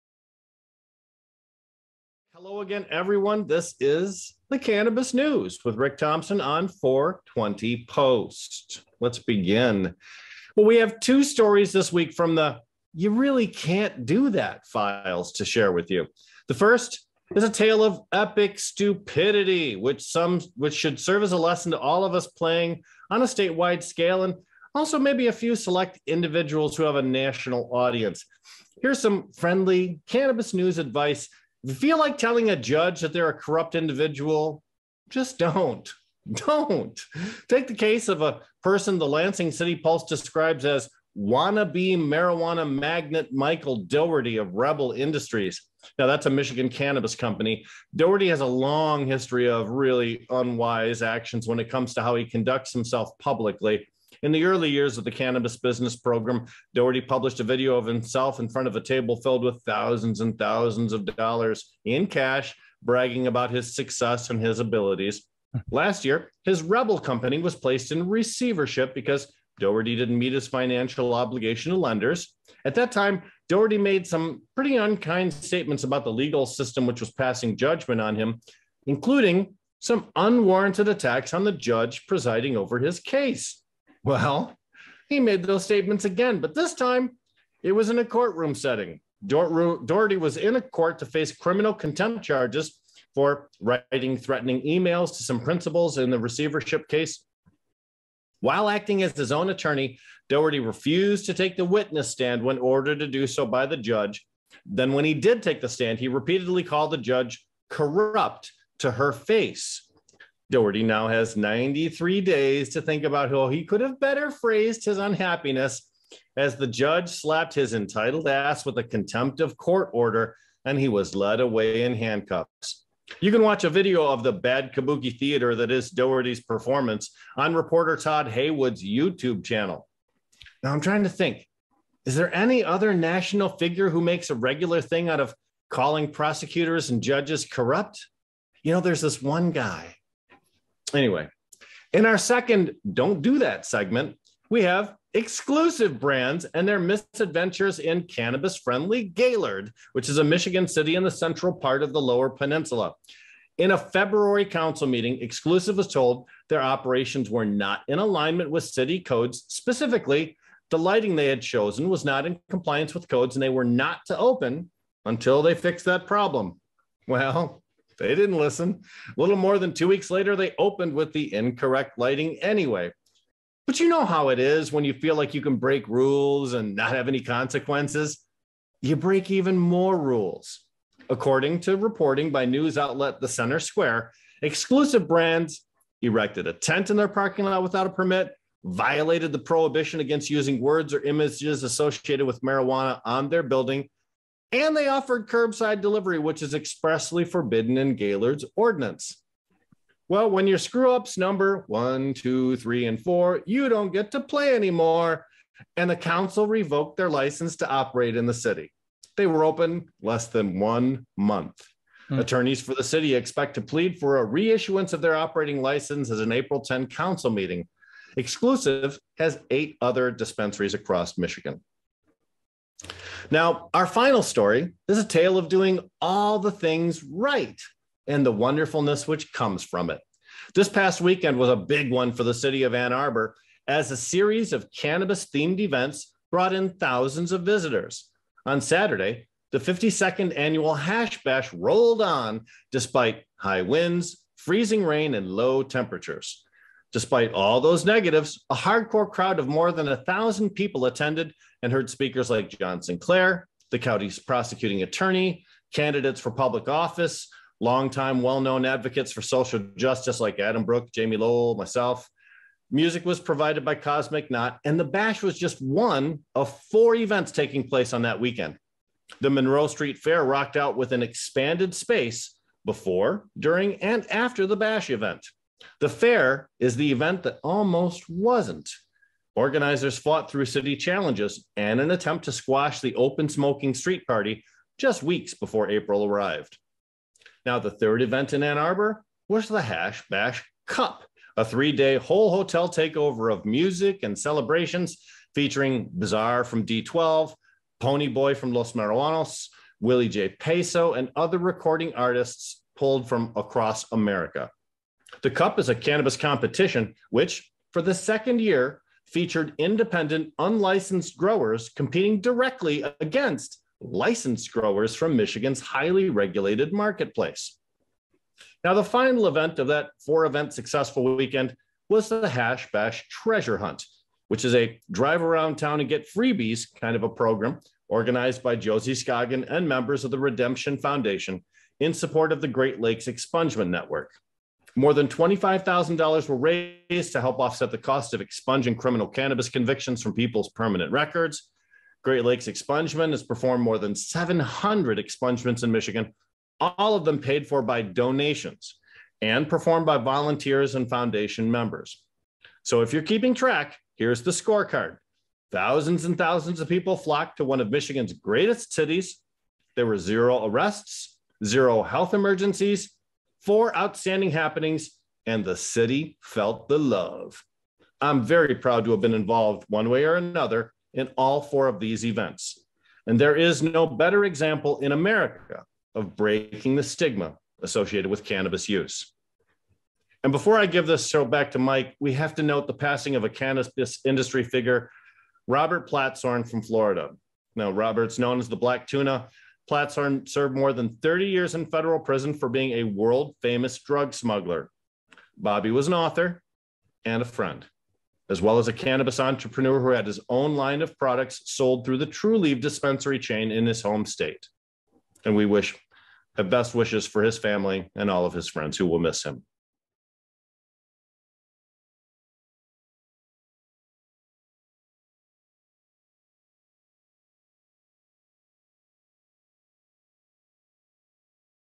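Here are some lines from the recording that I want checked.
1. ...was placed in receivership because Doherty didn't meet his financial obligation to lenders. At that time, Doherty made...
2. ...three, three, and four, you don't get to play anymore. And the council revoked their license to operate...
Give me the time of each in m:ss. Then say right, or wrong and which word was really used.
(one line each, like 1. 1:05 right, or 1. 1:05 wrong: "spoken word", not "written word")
1. 1:07 right
2. 3:22 wrong: "two", not "three".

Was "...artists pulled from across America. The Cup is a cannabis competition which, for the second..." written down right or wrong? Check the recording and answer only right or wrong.
right.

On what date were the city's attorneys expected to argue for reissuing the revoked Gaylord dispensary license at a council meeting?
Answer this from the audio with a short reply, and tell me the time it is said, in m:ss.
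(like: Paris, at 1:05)
April 10, at 3:36.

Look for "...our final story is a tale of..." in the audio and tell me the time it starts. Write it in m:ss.
3:43.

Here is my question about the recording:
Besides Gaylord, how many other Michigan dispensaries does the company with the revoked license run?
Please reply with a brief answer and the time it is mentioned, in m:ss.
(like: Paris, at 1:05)
8, at 3:39.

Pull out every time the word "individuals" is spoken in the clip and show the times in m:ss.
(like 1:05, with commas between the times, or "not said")
0:26, 0:33.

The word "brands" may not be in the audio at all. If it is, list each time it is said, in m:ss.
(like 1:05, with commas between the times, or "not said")
2:25, 3:05.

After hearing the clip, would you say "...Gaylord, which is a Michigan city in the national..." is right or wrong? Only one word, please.
wrong.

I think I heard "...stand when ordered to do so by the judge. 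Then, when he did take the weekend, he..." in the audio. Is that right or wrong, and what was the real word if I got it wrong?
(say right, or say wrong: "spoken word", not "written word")
wrong: "stand", not "weekend".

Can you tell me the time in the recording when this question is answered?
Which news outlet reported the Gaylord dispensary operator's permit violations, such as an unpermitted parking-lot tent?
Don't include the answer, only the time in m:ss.
3:03.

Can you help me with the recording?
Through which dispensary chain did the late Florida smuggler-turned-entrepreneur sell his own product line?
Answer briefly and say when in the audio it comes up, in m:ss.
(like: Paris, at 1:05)
Trulieve, at 6:42.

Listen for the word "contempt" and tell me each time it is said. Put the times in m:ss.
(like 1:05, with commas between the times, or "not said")
1:31, 1:58.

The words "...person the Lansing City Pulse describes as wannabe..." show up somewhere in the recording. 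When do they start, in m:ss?
0:38.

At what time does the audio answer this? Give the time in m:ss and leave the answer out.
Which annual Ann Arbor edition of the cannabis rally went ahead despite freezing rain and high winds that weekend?
3:59.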